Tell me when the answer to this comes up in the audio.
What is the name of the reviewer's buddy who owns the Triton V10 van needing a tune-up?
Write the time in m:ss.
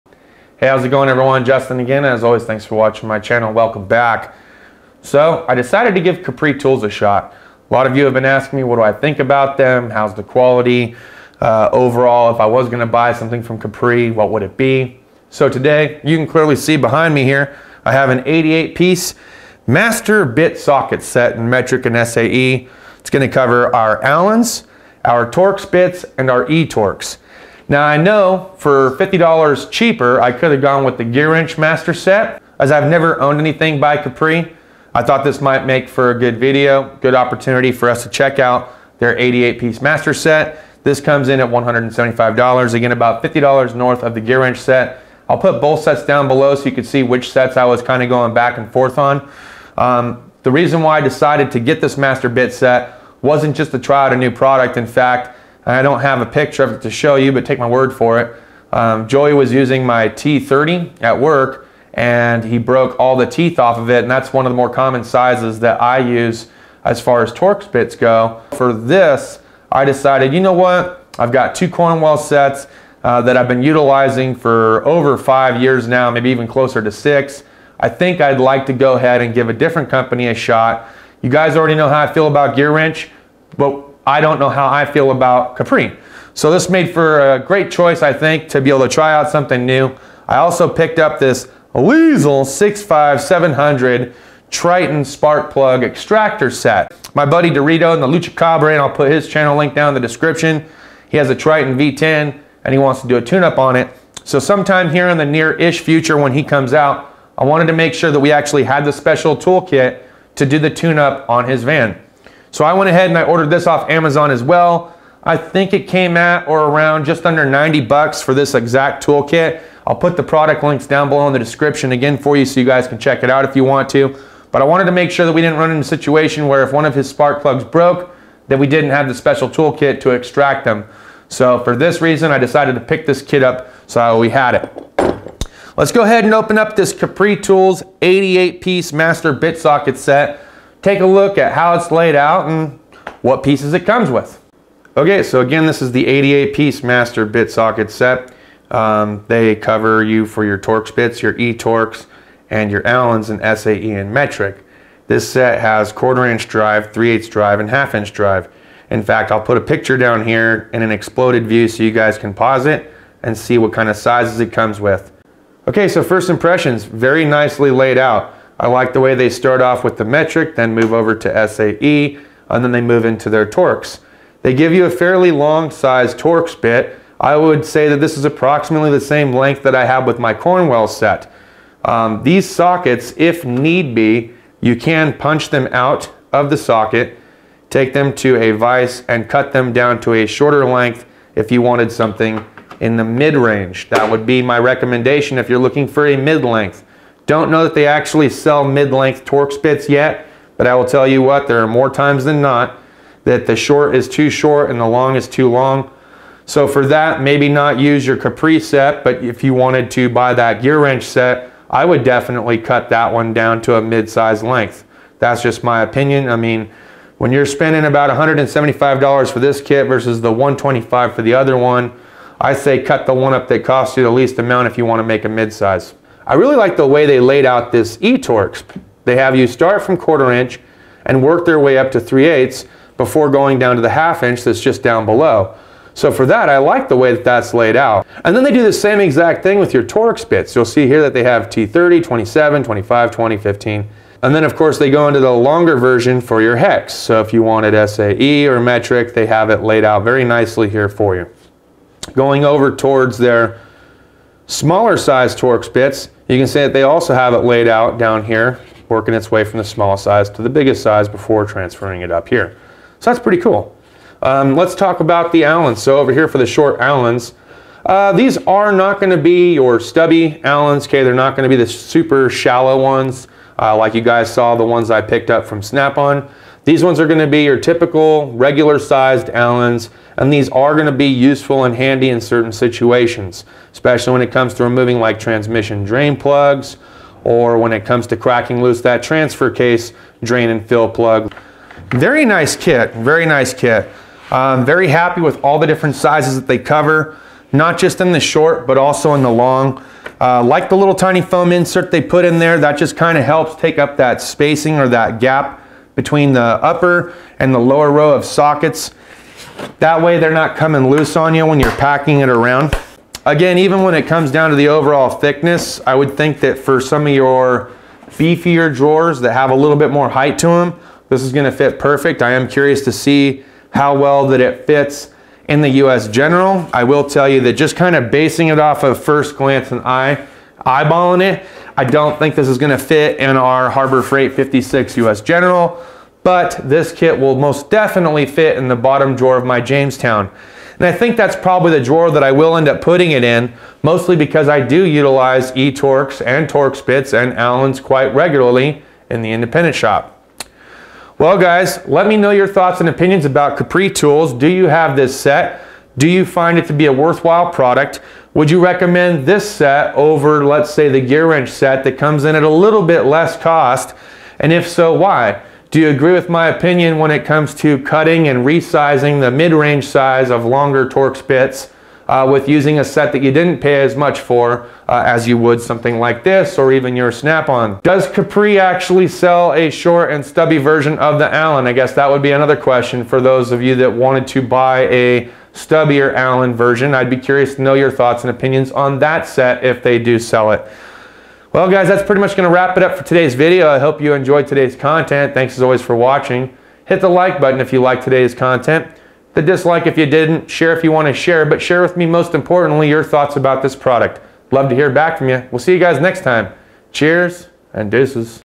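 1:37.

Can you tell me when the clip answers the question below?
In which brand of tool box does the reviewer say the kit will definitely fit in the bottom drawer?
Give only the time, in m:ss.
5:39.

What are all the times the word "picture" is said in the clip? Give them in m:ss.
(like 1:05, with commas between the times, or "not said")
0:56, 2:39.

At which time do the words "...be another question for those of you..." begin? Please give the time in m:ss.
6:22.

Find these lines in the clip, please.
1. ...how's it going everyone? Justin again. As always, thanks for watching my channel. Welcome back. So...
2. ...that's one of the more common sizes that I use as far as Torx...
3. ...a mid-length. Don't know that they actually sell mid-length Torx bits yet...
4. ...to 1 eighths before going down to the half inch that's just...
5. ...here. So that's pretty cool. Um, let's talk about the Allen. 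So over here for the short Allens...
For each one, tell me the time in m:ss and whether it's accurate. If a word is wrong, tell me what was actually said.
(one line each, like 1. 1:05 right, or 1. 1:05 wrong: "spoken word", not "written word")
1. 0:00 right
2. 1:04 right
3. 3:16 right
4. 3:51 wrong: "3", not "1"
5. 4:22 right.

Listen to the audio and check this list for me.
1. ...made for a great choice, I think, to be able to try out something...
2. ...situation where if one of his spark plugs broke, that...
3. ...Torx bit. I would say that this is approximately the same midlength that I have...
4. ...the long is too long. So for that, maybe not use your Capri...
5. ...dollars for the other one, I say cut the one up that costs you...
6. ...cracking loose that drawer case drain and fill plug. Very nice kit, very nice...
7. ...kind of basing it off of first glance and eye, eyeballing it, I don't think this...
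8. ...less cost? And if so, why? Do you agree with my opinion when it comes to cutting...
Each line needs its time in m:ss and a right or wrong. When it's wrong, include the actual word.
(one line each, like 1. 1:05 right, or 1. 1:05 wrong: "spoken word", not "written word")
1. 1:26 right
2. 2:05 right
3. 2:56 wrong: "length", not "midlength"
4. 3:24 right
5. 3:40 right
6. 4:48 wrong: "transfer", not "drawer"
7. 5:27 right
8. 6:03 right.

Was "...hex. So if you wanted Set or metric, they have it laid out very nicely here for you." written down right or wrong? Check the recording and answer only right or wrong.
wrong.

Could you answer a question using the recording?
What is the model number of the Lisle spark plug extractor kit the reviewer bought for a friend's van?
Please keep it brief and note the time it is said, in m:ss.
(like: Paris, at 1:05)
65700, at 1:32.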